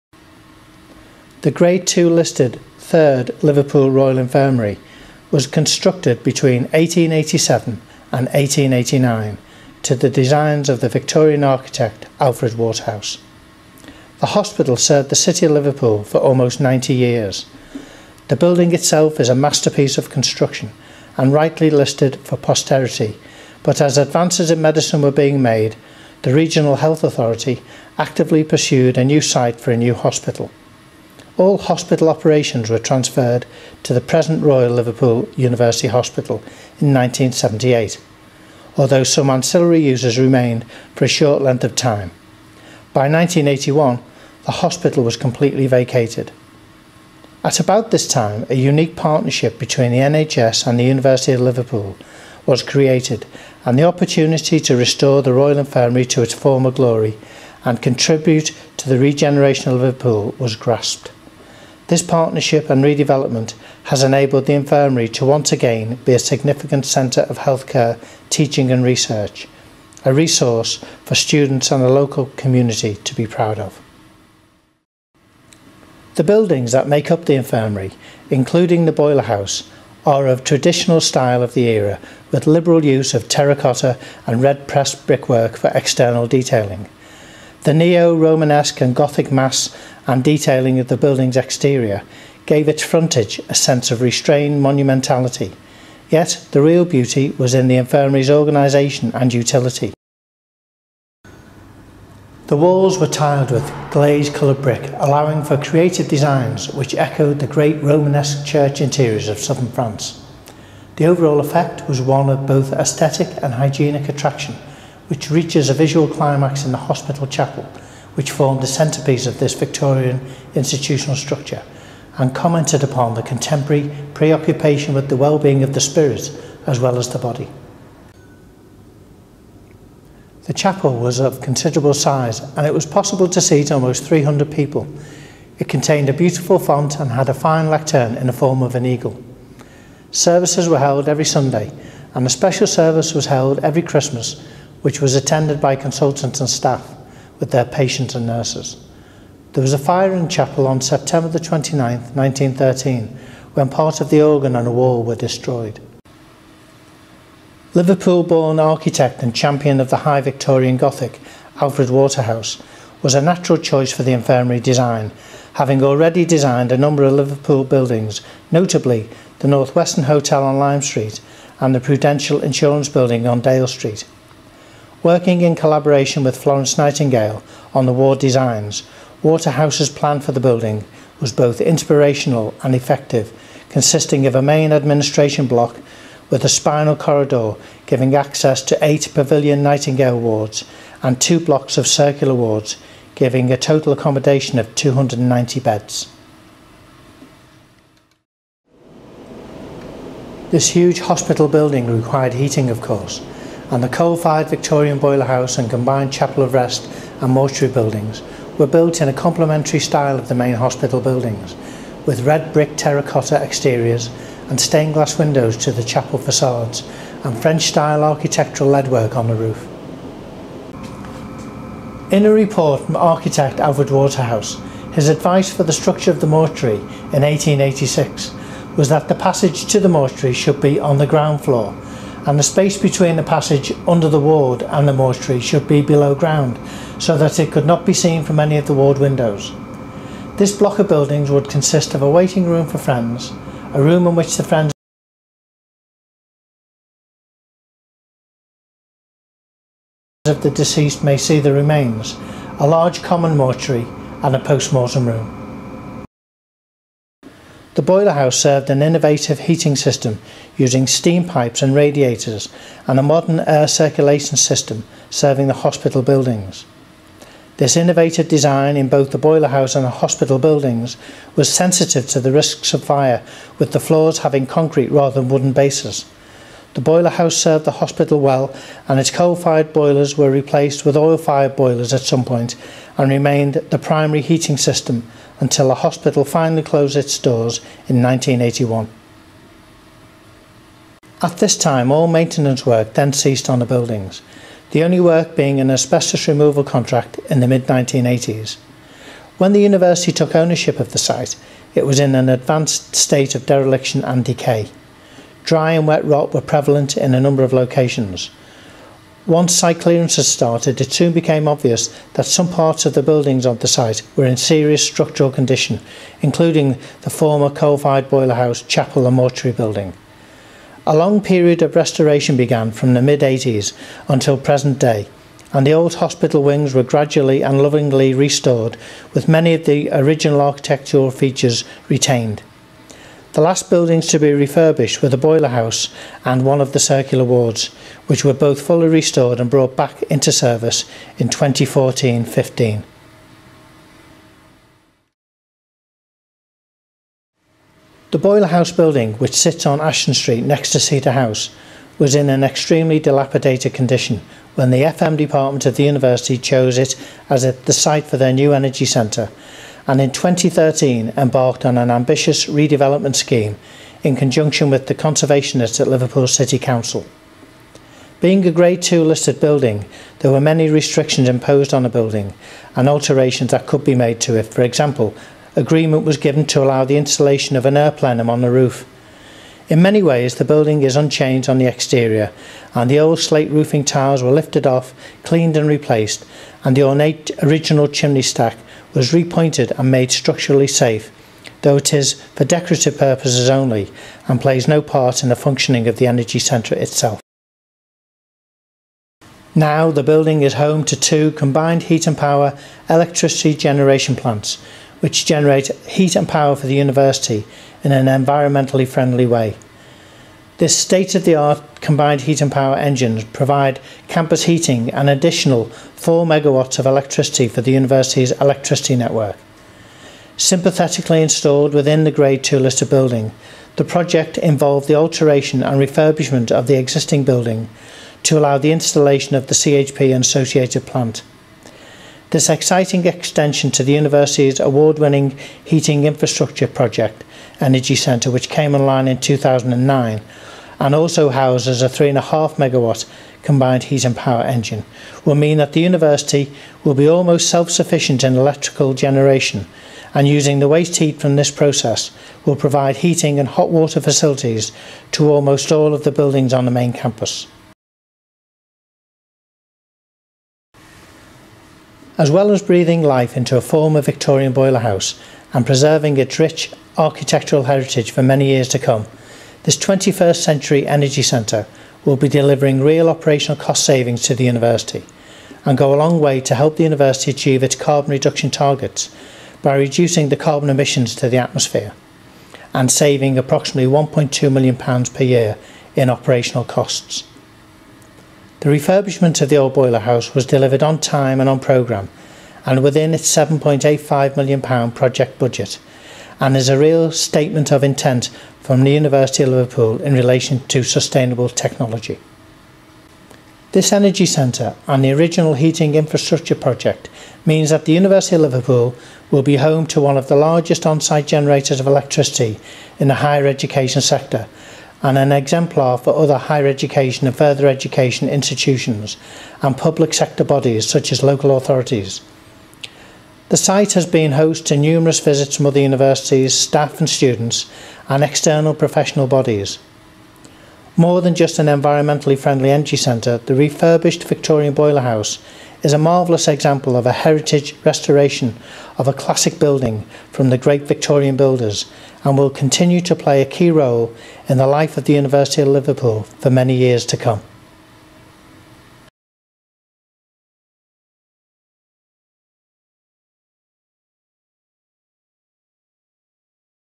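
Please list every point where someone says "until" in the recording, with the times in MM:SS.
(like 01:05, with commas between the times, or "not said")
04:45, 05:24.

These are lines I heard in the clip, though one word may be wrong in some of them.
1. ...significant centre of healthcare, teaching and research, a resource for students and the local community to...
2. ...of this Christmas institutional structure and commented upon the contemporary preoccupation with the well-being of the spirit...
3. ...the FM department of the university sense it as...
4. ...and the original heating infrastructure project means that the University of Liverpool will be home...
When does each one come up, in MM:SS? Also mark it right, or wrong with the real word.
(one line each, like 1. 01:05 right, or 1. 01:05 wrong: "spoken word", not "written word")
1. 01:06 right
2. 01:59 wrong: "Victorian", not "Christmas"
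3. 05:54 wrong: "chose", not "sense"
4. 08:24 right.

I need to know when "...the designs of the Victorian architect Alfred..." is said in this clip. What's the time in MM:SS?
00:09.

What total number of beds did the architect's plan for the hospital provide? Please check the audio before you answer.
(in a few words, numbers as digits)
290.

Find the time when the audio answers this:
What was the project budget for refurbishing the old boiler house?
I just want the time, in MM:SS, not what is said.
08:13.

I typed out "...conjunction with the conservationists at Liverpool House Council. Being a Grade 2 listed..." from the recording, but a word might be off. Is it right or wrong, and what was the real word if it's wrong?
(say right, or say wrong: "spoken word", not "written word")
wrong: "City", not "House".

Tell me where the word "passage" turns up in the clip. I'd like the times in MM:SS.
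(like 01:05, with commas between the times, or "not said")
03:49, 03:53.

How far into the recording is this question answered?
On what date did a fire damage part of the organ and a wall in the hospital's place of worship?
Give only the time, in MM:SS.
02:30.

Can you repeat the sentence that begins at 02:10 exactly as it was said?
The chapel was of considerable size and it was possible to seat almost 300 people.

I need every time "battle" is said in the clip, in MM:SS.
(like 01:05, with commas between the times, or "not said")
not said.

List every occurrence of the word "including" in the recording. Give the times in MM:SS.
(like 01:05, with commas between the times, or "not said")
01:18, 05:16.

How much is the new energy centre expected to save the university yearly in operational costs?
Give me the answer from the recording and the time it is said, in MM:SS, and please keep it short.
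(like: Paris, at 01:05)
£1.2 million, at 08:03.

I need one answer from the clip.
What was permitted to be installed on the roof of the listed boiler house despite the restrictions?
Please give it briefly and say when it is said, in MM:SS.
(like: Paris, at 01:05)
An air plenum, at 06:17.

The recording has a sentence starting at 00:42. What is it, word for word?
By 1981, the hospital was completely vacated.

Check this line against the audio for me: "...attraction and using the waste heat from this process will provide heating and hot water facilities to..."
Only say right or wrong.
wrong.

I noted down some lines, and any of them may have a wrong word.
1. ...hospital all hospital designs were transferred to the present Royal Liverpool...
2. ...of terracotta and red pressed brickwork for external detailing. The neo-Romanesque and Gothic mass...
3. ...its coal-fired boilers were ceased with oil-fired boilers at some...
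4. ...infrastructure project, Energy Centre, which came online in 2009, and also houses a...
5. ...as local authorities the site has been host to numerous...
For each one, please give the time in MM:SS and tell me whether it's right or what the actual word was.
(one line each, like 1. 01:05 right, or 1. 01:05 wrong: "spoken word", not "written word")
1. 00:29 wrong: "operations", not "designs"
2. 01:23 right
3. 04:38 wrong: "replaced", not "ceased"
4. 07:16 right
5. 08:41 right.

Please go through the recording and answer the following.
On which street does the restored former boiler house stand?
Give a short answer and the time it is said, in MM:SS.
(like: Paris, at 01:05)
Ashton Street, at 05:49.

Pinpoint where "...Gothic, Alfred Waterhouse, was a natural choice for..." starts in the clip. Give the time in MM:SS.
02:40.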